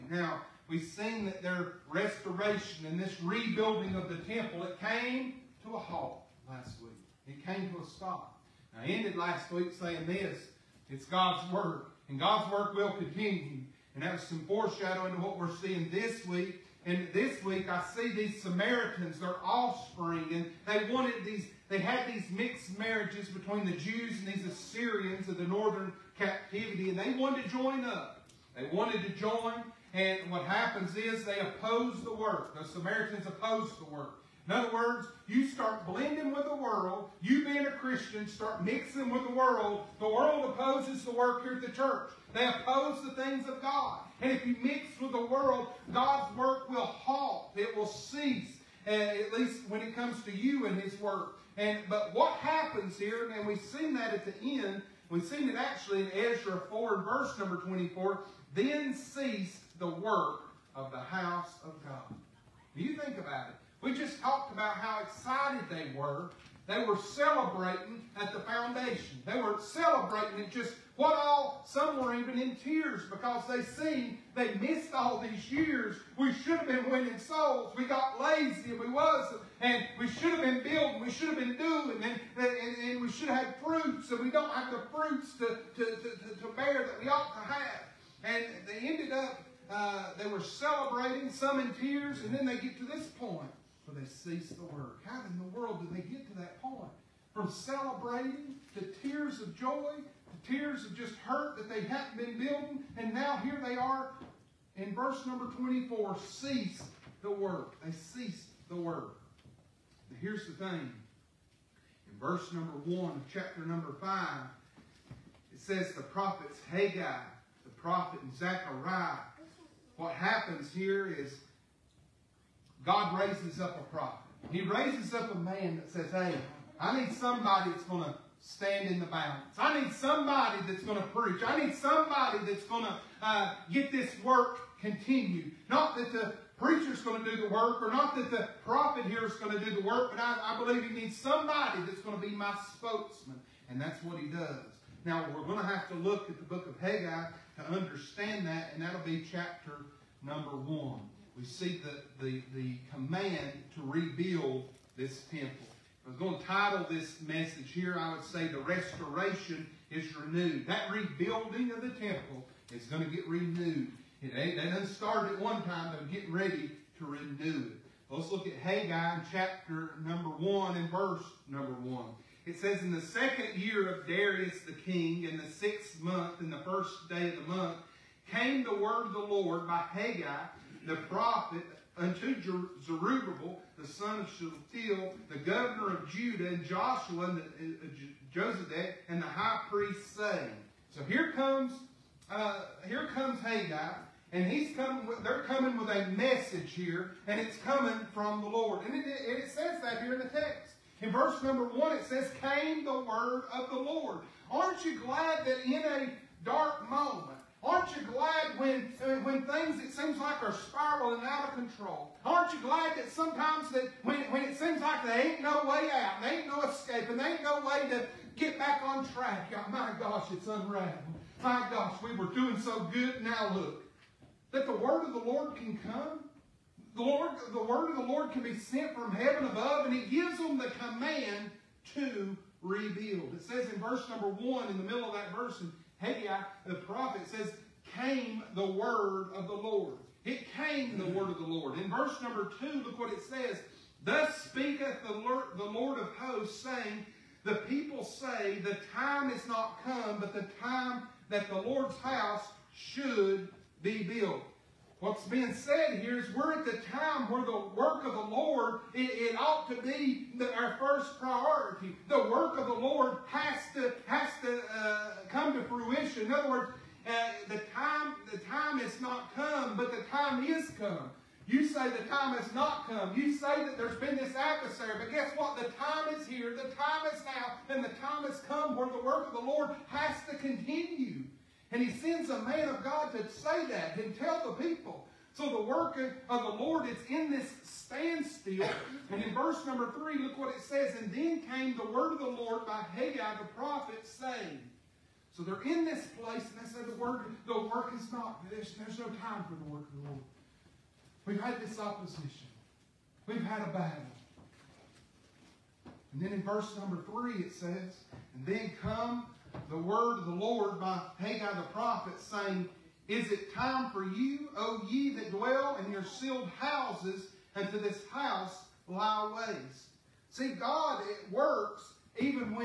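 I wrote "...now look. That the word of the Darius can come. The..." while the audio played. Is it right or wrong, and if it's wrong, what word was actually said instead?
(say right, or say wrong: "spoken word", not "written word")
wrong: "Lord", not "Darius".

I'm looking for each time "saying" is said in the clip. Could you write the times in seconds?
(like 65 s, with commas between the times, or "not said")
9 s, 190 s, 246 s, 294 s, 312 s.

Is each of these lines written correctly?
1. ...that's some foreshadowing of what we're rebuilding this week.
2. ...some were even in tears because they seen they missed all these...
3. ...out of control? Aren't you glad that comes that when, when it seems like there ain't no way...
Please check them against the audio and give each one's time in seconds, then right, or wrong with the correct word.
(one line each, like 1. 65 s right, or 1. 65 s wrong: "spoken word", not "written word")
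1. 14 s wrong: "seeing", not "rebuilding"
2. 71 s right
3. 211 s wrong: "sometimes", not "comes".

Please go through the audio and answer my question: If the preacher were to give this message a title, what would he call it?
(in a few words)
The restoration is renewed.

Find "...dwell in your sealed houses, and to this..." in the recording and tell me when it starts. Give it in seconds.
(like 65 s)
315 s.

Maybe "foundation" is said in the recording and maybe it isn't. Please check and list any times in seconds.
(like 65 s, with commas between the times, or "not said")
68 s.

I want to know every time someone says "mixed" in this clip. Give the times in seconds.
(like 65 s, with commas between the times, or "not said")
22 s.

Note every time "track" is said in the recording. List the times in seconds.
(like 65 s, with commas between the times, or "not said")
219 s.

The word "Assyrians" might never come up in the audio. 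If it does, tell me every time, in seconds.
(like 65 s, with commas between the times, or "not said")
24 s.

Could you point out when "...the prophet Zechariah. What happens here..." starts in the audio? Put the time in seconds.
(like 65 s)
117 s.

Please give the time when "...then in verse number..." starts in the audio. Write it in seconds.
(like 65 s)
306 s.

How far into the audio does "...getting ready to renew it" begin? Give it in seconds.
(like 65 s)
166 s.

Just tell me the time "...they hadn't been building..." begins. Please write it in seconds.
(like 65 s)
101 s.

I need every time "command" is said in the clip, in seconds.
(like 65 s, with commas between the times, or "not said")
152 s, 230 s.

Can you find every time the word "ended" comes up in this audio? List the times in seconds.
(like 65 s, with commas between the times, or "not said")
8 s, 88 s.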